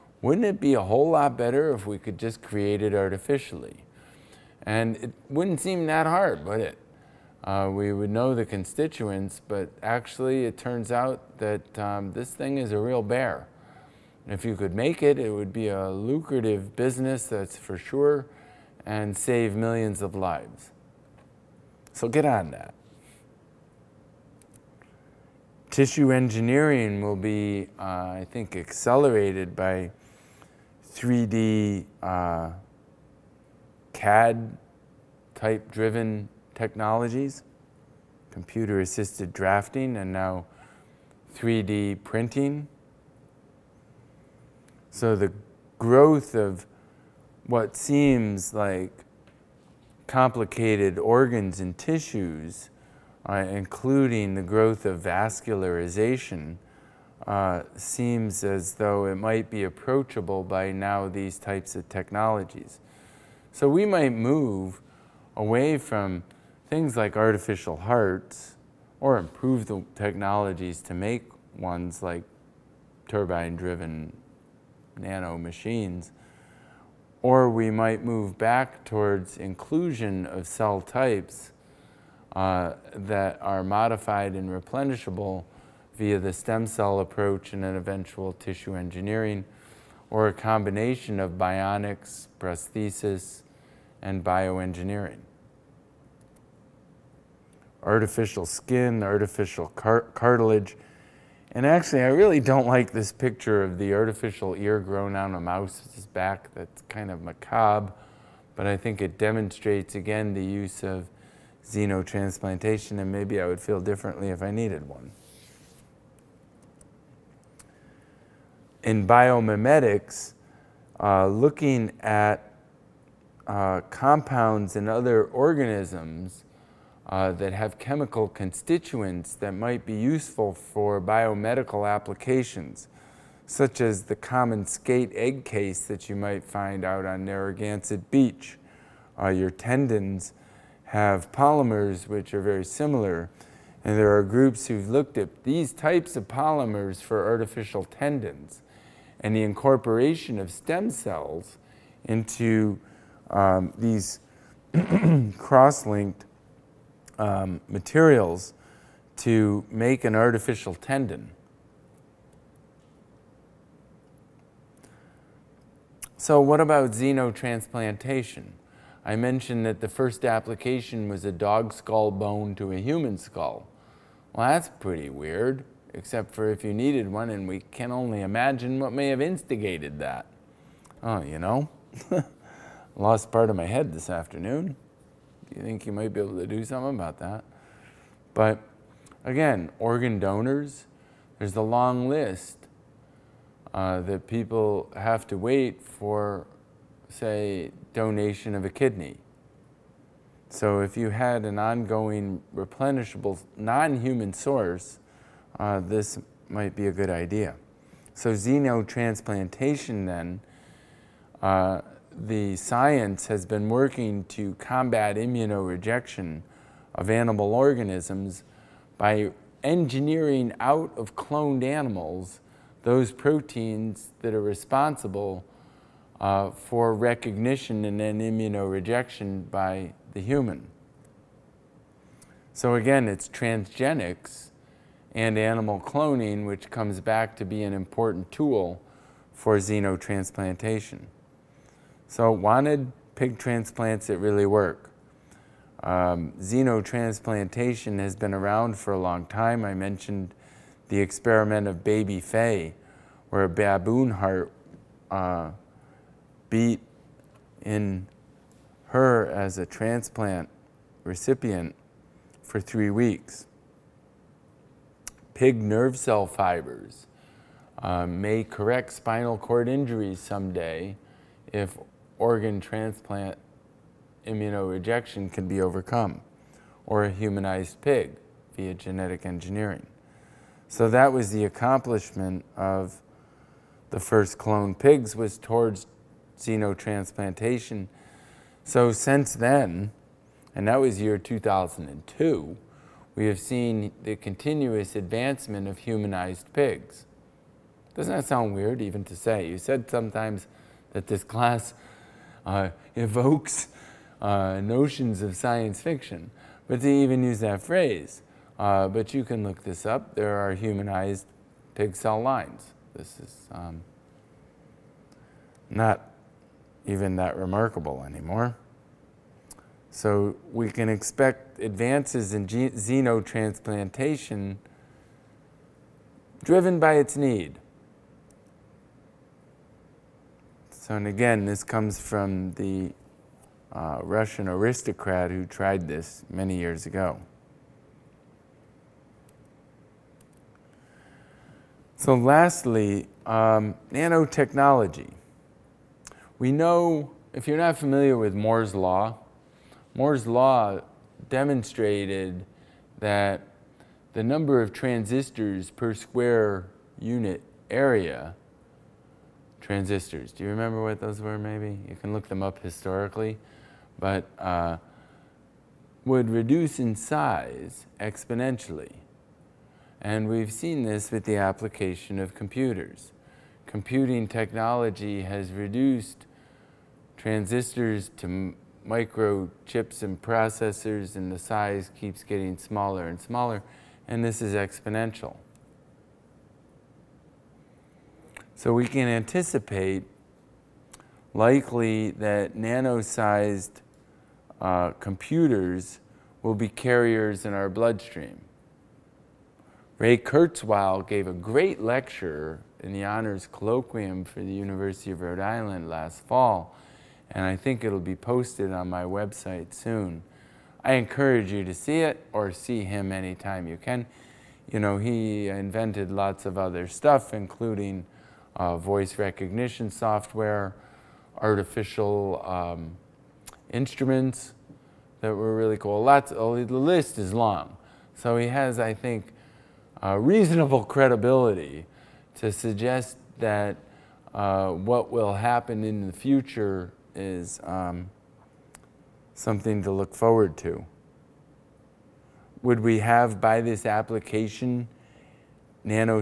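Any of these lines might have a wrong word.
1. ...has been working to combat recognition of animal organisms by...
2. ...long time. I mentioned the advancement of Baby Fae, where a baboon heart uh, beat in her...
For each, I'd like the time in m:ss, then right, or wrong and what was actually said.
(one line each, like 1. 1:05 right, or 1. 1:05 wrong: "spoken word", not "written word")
1. 3:33 wrong: "immunorejection", not "recognition"
2. 4:08 wrong: "experiment", not "advancement".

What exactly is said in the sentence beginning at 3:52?
So again, it's transgenics and animal cloning, which comes back to be an important tool for xenotransplantation.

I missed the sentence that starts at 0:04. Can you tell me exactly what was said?
And it wouldn't seem that hard, would it?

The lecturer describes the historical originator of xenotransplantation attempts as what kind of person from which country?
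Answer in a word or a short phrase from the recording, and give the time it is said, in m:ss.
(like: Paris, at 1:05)
Russian aristocrat, at 5:34.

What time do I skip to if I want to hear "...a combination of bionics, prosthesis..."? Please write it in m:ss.
1:30.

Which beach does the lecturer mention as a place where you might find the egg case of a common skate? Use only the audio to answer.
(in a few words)
Narragansett Beach.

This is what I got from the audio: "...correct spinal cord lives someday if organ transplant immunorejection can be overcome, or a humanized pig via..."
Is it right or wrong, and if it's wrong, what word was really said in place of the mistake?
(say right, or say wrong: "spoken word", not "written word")
wrong: "injuries", not "lives".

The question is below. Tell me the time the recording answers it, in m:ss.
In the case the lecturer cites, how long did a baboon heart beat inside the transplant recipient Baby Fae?
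4:22.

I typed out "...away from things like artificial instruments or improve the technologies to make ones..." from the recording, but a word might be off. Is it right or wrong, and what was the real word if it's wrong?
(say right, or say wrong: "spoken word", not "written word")
wrong: "hearts", not "instruments".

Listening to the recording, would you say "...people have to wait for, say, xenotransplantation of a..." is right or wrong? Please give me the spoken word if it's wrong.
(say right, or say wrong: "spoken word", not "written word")
wrong: "donation", not "xenotransplantation".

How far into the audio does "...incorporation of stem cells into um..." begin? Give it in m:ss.
2:29.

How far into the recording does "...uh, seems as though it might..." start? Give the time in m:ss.
0:57.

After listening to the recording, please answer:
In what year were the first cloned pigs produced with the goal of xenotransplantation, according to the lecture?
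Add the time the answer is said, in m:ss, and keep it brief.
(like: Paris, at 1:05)
2002, at 4:51.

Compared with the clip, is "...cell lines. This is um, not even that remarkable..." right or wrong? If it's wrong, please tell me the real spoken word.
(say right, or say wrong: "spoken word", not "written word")
right.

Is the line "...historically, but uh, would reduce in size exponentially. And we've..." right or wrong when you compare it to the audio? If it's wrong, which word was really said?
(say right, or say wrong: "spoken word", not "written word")
right.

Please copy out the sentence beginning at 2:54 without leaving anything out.
Well, that's pretty weird, except for if you needed one, and we can only imagine what may have instigated that.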